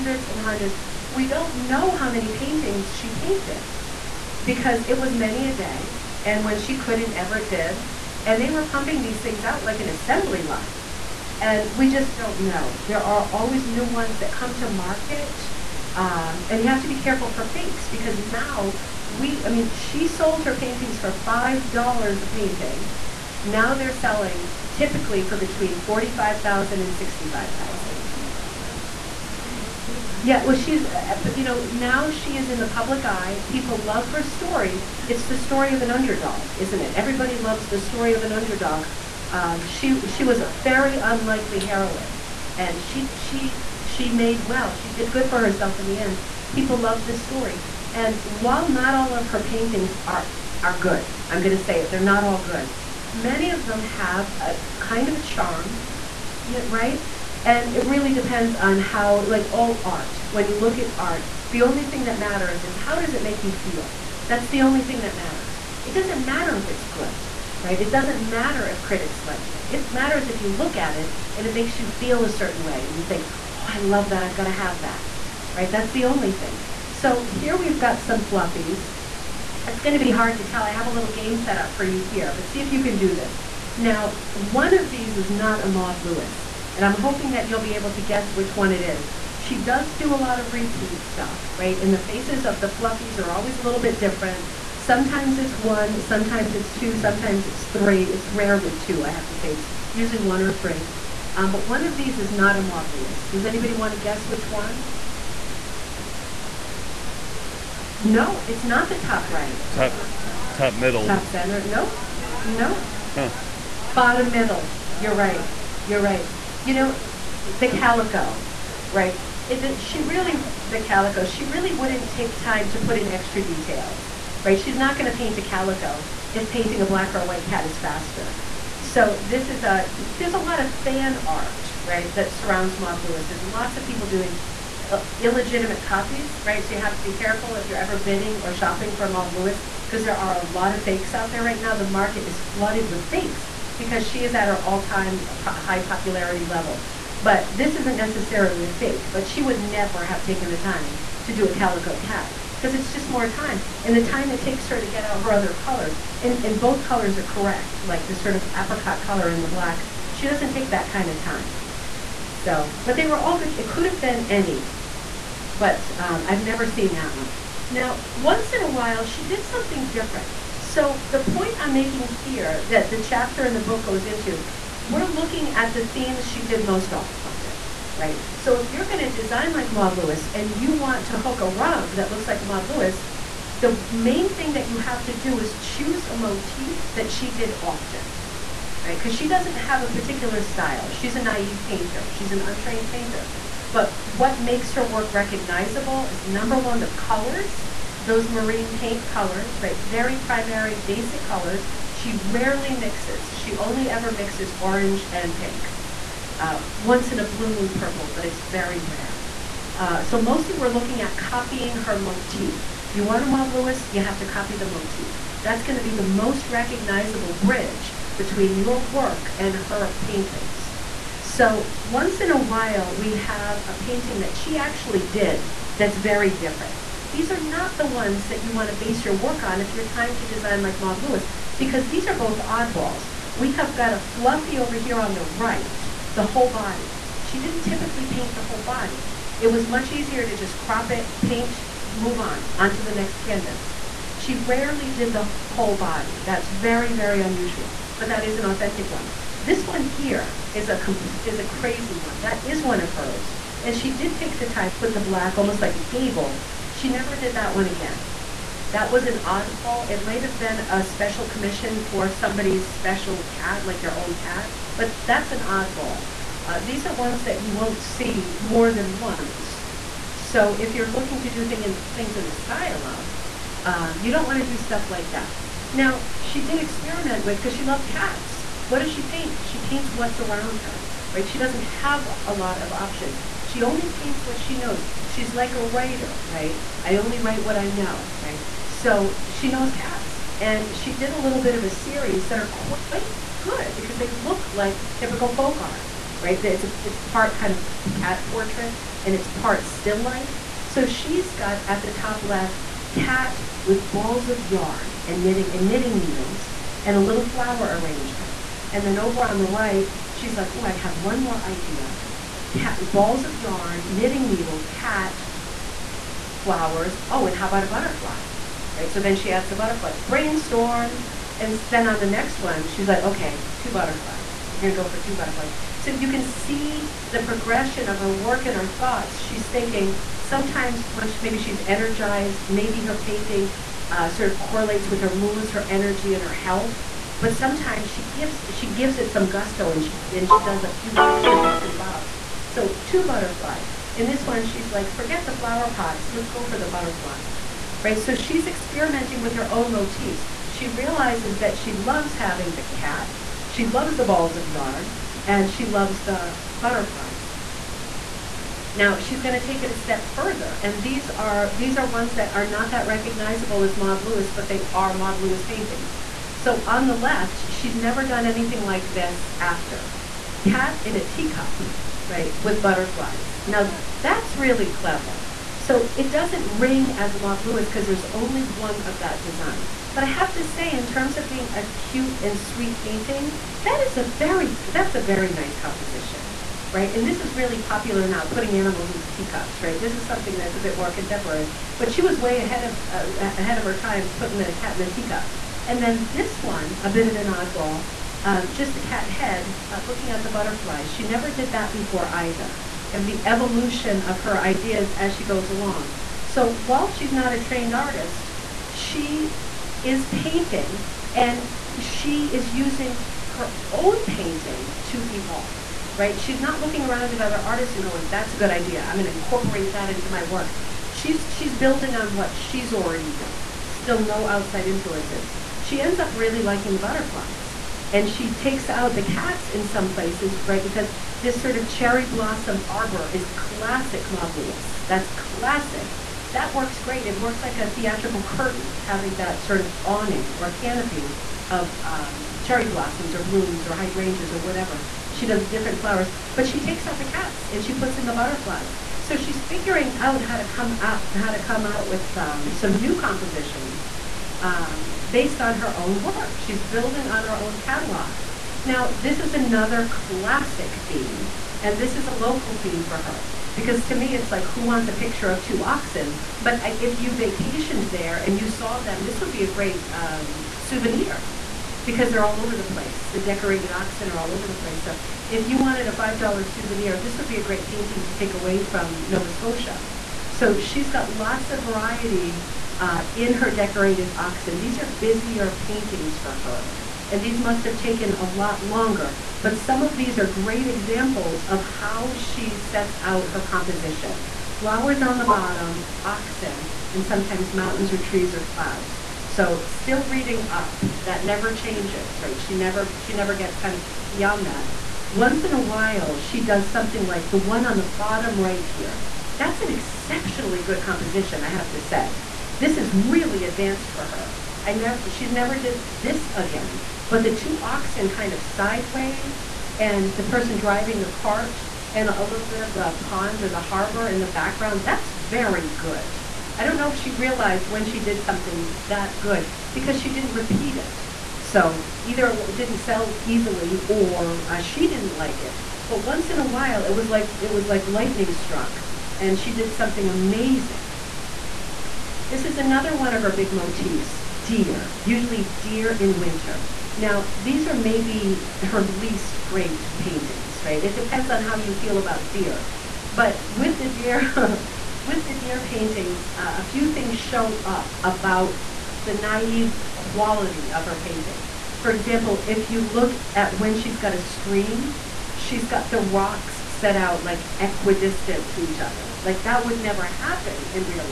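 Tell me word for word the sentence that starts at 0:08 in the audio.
And they were pumping these things out like an assembly line and we just don't know.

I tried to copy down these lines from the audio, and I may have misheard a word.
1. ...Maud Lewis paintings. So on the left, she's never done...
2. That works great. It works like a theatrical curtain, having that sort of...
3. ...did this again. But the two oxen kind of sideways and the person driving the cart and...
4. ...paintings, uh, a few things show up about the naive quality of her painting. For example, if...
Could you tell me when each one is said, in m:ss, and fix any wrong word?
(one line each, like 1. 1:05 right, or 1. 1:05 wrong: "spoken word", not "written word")
1. 6:04 right
2. 7:16 right
3. 8:35 right
4. 9:15 right.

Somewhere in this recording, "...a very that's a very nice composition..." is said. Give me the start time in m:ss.
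6:23.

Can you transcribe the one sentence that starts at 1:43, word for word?
Does anybody want to guess which one?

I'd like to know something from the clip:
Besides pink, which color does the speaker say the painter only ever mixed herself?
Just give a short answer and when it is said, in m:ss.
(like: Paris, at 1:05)
orange, at 3:24.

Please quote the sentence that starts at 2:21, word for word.
The market is flooded with fakes because she is at her all-time po- high popularity level.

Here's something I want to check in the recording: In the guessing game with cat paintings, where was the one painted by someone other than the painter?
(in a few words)
Bottom middle.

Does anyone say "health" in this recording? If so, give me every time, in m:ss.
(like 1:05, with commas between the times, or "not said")
5:36.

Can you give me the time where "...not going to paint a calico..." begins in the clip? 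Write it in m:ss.
2:04.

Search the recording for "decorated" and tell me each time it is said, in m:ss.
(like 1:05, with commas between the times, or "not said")
7:53, 8:03.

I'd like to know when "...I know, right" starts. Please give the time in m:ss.
4:47.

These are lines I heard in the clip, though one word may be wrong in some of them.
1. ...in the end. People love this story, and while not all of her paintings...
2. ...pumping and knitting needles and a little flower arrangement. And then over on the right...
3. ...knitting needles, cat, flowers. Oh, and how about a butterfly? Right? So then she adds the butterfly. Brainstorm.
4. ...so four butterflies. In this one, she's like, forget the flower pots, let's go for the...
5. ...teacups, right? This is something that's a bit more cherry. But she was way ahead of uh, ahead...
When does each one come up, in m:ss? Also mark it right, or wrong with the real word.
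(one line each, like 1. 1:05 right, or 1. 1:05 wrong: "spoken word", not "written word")
1. 0:45 right
2. 5:05 wrong: "knitting", not "pumping"
3. 5:13 right
4. 5:42 wrong: "two", not "four"
5. 6:29 wrong: "contemporary", not "cherry".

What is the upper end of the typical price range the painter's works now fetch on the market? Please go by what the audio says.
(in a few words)
$65,000.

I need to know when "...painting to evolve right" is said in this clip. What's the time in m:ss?
6:54.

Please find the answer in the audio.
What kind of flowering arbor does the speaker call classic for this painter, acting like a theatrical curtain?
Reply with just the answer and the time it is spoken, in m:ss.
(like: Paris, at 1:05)
cherry blossom, at 7:11.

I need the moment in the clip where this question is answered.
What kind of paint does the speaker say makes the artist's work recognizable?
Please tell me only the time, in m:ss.
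3:18.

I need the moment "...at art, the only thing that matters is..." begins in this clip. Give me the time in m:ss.
1:00.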